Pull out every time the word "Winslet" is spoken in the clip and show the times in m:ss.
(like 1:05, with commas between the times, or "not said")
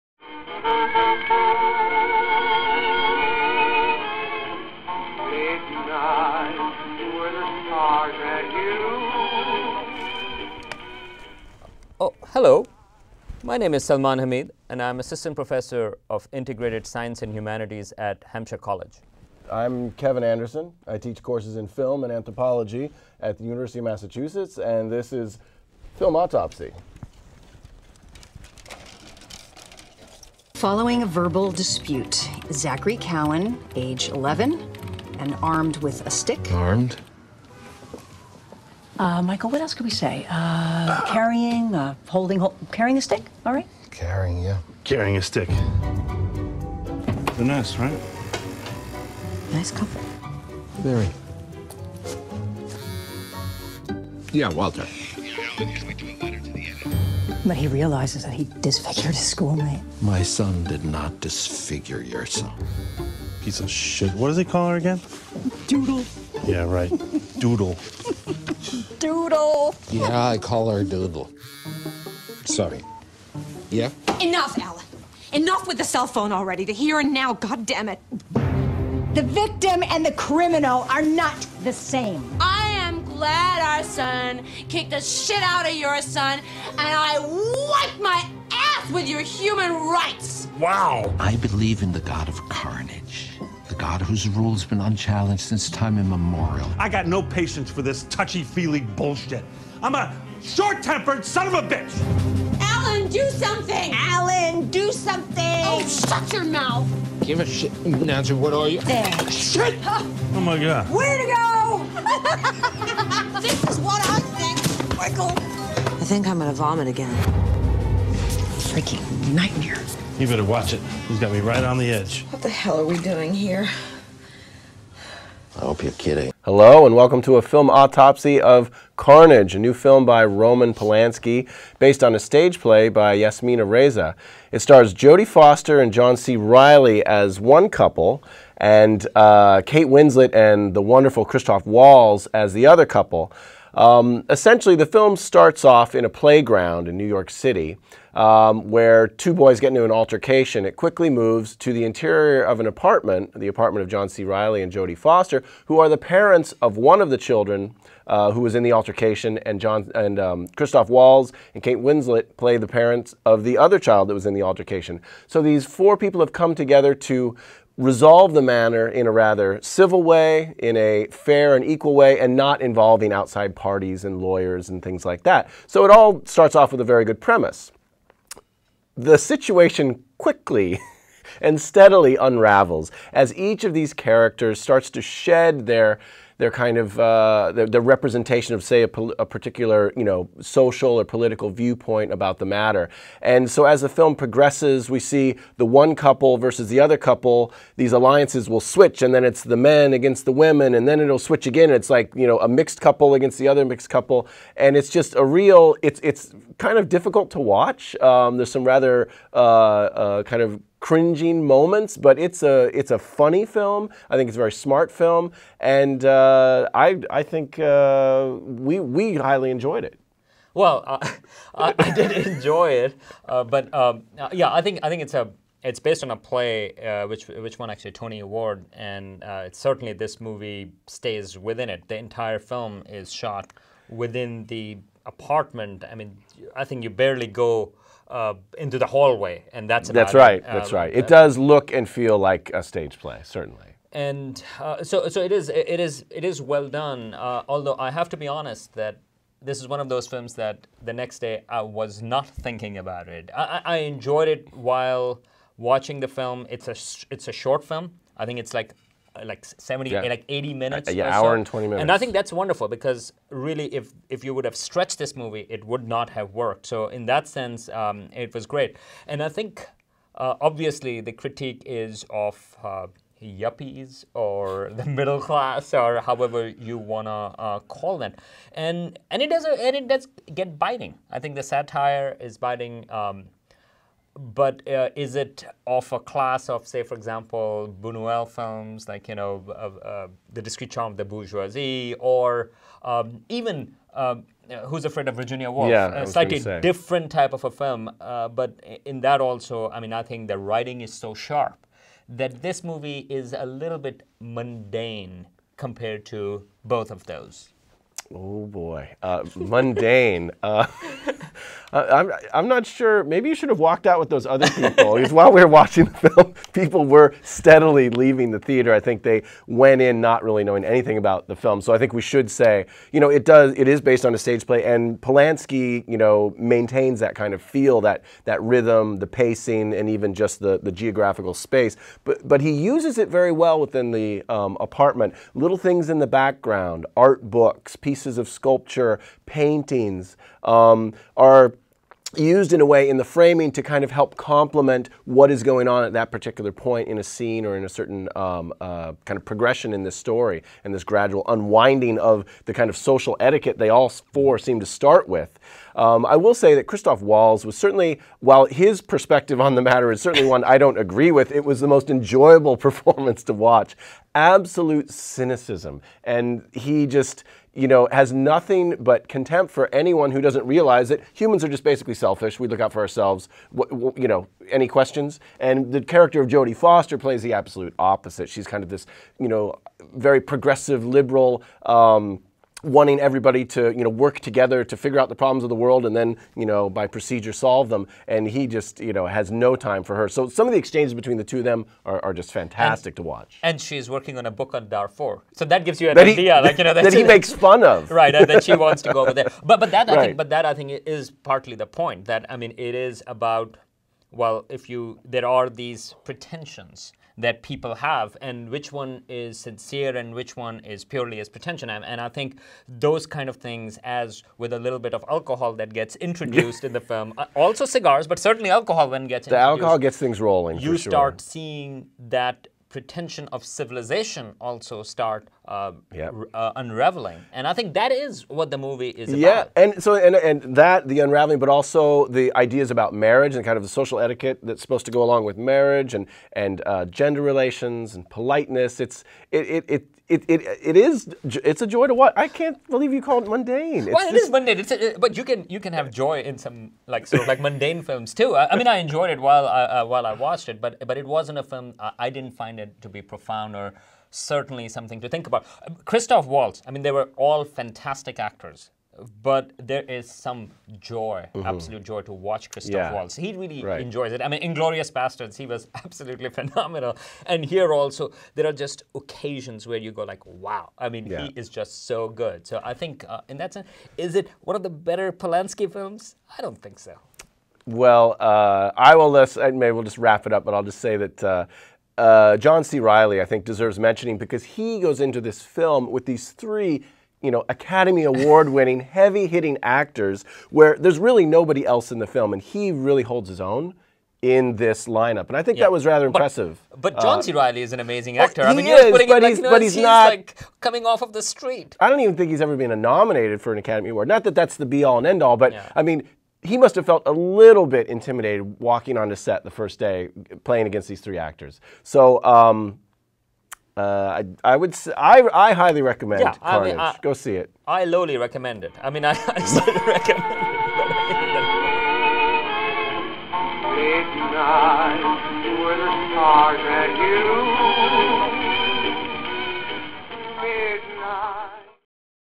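2:19, 2:41.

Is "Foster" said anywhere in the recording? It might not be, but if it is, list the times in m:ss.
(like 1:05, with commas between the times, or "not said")
2:15, 2:34, 6:16.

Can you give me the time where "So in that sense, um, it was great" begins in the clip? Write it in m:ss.
4:26.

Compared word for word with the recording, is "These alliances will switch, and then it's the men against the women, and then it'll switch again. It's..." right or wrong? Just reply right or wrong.
right.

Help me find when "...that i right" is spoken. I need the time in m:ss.
6:39.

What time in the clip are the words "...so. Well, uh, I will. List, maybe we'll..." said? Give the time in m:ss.
7:56.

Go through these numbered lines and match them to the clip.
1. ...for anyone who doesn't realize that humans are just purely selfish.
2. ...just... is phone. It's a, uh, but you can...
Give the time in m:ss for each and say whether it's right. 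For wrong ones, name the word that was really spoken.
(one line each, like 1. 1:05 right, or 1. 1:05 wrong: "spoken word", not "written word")
1. 6:09 wrong: "basically", not "purely"
2. 7:24 wrong: "mundane", not "phone".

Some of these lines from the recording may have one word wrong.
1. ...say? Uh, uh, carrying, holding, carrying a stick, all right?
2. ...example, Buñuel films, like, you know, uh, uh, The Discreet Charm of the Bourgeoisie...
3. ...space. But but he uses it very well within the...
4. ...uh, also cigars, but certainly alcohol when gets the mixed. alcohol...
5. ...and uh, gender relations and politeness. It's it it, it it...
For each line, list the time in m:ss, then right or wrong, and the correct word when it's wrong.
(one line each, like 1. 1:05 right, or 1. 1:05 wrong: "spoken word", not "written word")
1. 0:39 right
2. 4:46 right
3. 5:31 right
4. 6:57 wrong: "introduced", not "mixed"
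5. 7:16 right.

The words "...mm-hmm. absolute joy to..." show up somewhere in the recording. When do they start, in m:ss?
7:41.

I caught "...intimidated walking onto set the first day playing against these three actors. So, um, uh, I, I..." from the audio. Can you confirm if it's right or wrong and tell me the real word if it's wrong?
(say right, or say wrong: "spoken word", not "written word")
right.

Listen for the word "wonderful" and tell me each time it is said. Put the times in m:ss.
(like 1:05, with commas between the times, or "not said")
2:20, 4:22.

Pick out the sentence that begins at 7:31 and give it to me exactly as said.
I, I didn't find it to be profound or certainly something to think about.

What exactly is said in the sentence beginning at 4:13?
I, I enjoyed it while watching the film.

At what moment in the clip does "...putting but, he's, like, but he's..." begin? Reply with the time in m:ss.
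8:18.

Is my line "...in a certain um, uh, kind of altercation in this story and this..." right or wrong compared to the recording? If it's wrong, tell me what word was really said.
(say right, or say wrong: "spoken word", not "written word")
wrong: "progression", not "altercation".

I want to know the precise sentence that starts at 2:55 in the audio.
So it all starts off with a very good premise.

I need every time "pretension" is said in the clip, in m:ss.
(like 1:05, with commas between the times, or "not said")
6:46, 6:51, 7:02.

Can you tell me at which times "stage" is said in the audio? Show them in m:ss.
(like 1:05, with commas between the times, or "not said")
2:12, 4:02, 5:24.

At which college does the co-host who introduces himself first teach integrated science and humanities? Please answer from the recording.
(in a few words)
Hampshire College.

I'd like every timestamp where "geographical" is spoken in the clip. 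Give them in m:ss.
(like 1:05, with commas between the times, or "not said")
5:30.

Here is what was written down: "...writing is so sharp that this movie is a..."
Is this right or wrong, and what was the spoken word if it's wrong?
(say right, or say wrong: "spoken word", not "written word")
right.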